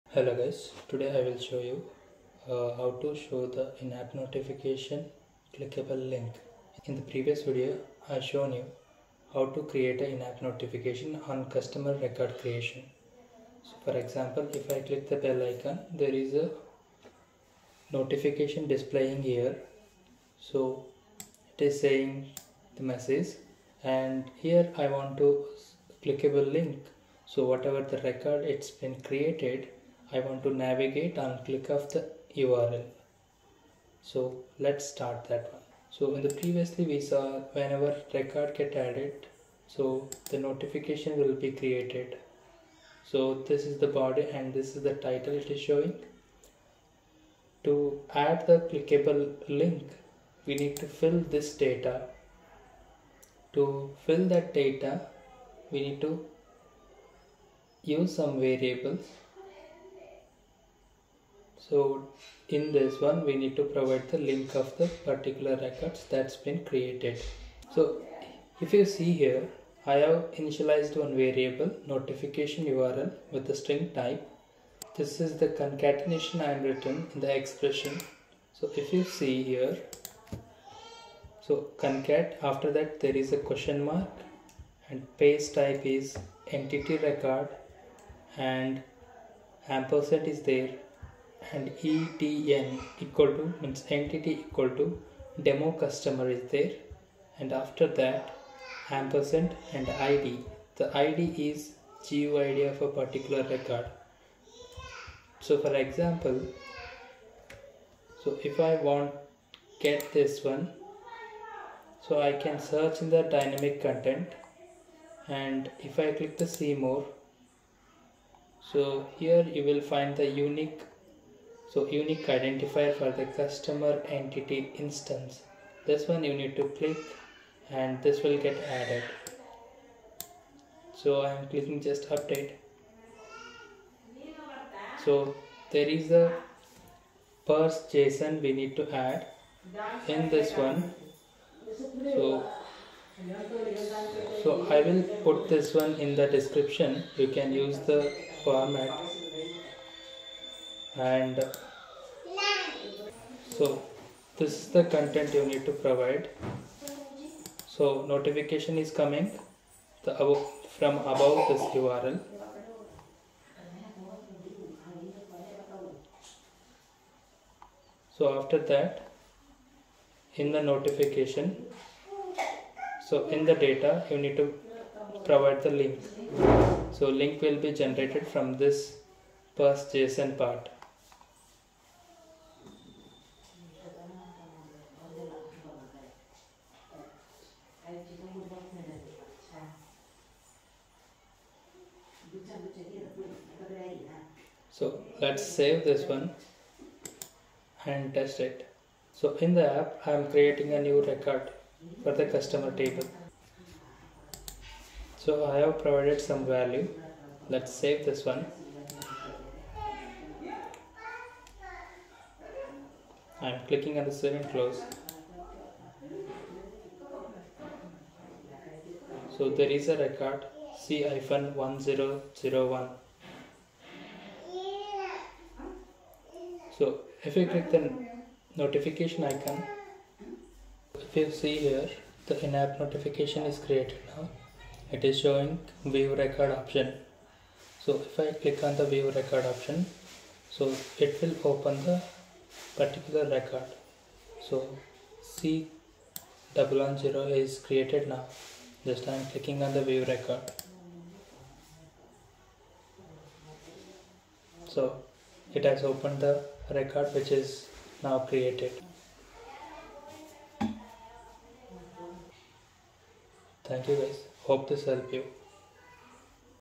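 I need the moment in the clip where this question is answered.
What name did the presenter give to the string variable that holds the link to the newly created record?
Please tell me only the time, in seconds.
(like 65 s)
71 s.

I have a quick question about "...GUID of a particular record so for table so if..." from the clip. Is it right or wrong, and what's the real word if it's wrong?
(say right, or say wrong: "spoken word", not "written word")
wrong: "example", not "table".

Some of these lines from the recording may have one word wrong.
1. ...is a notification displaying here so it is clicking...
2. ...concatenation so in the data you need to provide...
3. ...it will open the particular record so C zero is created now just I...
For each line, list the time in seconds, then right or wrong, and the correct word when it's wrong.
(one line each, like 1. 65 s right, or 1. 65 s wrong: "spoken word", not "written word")
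1. 16 s wrong: "saying", not "clicking"
2. 170 s wrong: "notification", not "concatenation"
3. 241 s right.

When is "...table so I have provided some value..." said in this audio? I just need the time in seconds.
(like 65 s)
202 s.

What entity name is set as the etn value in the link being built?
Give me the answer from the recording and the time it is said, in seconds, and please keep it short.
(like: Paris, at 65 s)
demo customer, at 95 s.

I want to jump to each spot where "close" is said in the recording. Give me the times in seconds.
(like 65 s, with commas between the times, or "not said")
214 s.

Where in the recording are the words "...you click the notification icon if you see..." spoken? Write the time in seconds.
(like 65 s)
227 s.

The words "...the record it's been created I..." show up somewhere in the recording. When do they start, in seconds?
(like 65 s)
27 s.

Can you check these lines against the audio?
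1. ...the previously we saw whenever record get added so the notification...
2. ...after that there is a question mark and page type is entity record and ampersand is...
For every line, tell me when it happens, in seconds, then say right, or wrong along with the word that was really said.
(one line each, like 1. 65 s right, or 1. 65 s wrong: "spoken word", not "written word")
1. 36 s right
2. 82 s right.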